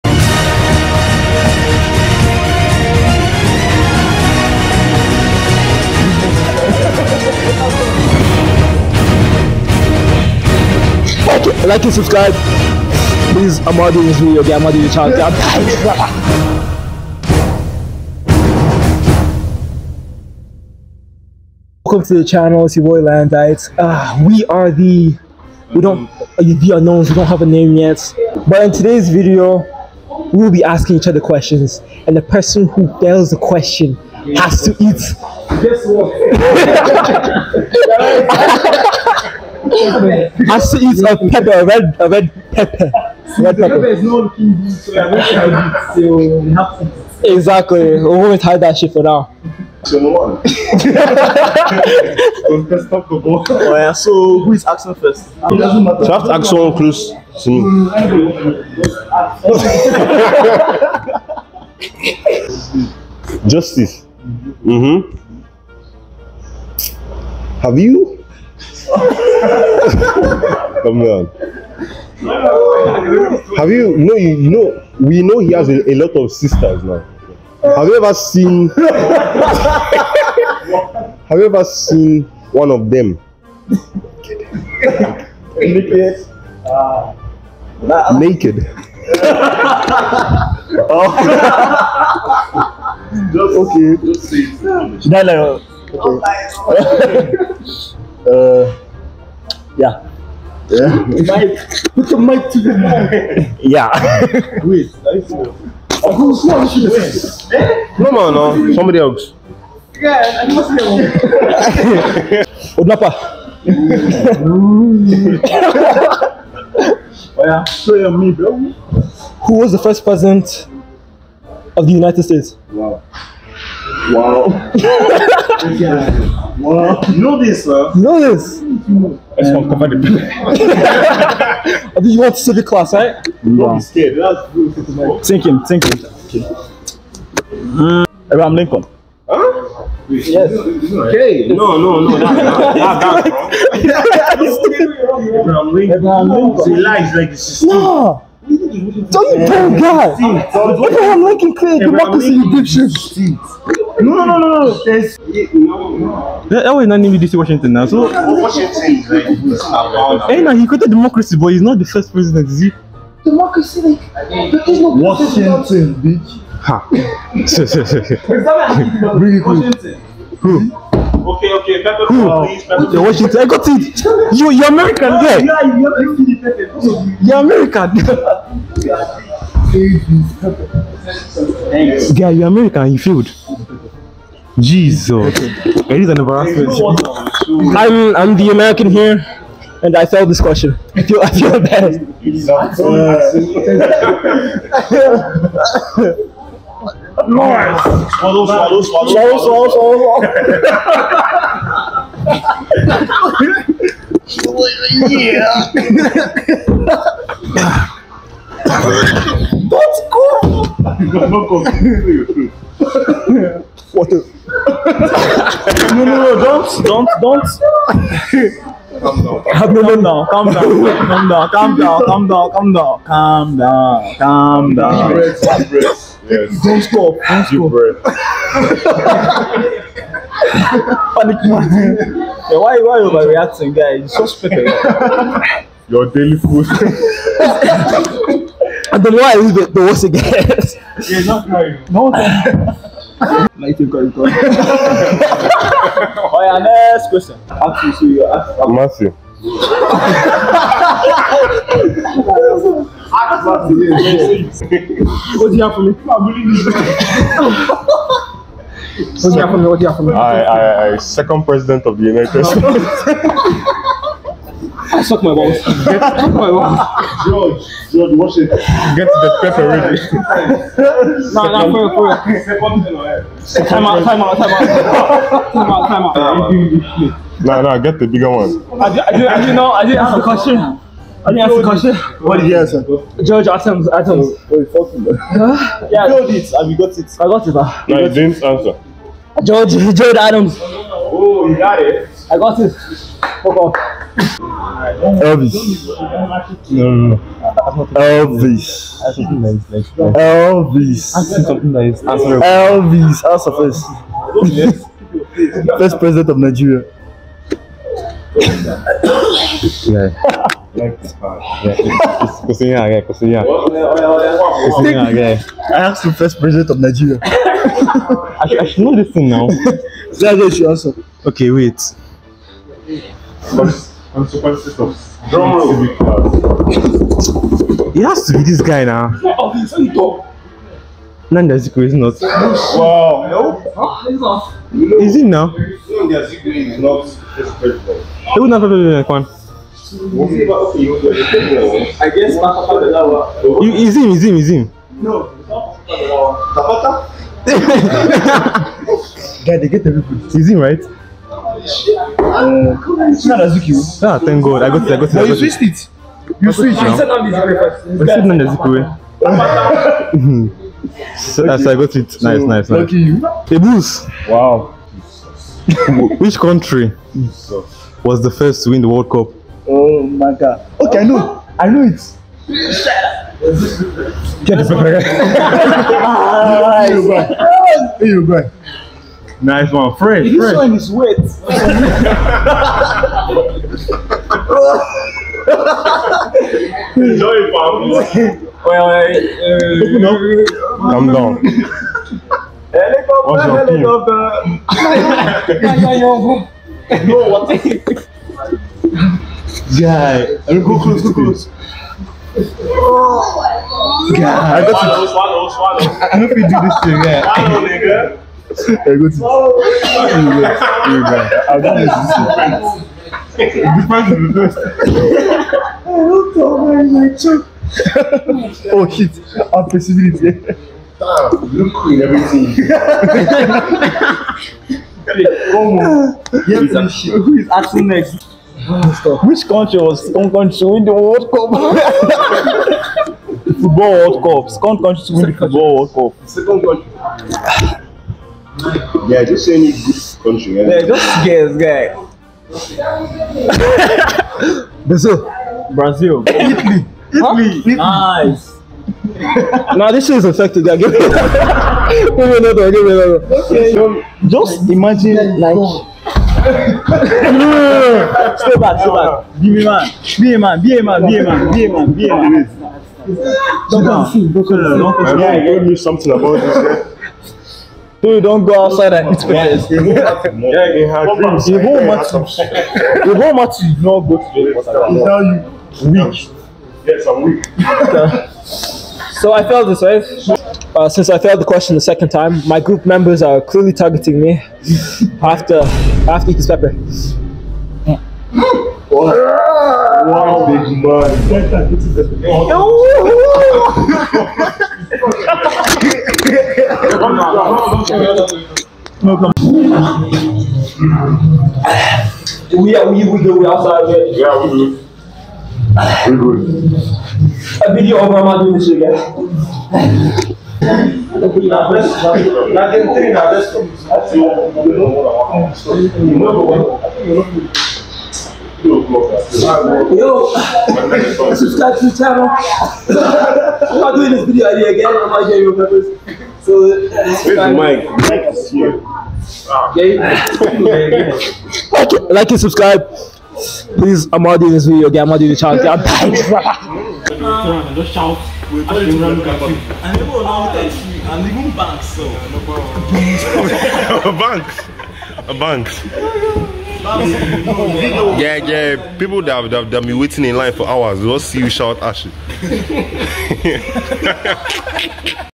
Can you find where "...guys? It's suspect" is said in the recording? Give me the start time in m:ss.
3:53.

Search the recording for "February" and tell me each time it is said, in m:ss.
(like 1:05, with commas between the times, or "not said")
not said.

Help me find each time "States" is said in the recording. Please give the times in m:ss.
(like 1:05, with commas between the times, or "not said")
2:02, 4:22.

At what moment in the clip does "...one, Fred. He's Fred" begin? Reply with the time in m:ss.
6:19.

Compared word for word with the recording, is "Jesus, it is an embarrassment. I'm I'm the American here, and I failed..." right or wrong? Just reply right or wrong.
right.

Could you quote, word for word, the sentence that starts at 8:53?
Please, I'm not doing this video again.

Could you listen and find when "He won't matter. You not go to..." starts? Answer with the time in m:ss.
7:52.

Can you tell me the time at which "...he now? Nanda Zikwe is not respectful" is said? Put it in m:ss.
5:35.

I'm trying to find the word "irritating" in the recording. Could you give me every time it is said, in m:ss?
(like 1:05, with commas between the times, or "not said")
not said.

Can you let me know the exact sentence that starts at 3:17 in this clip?
Lord, swallow, swallow, swallow, swallow, swallow.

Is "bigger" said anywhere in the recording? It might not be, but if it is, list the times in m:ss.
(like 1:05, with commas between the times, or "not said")
4:38.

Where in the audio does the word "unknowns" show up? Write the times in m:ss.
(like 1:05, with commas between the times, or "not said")
0:26.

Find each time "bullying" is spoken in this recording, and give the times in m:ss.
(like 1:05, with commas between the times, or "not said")
4:16.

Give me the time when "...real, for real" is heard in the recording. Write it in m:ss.
4:31.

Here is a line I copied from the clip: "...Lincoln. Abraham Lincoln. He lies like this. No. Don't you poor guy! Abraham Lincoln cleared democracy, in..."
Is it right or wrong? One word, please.
right.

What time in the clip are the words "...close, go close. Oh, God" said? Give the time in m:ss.
6:40.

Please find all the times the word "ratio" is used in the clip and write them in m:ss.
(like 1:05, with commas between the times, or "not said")
not said.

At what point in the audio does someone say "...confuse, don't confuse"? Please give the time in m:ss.
7:44.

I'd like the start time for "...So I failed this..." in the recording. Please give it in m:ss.
7:59.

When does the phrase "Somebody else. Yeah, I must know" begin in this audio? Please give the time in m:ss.
1:48.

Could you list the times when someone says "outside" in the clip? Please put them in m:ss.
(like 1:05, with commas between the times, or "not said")
7:48, 8:23.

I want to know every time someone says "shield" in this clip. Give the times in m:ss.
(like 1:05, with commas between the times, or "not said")
not said.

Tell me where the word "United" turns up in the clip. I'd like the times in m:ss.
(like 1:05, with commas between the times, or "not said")
2:01, 4:22.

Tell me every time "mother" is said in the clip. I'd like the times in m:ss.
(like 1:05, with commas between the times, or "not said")
8:28.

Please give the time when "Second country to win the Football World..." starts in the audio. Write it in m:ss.
7:14.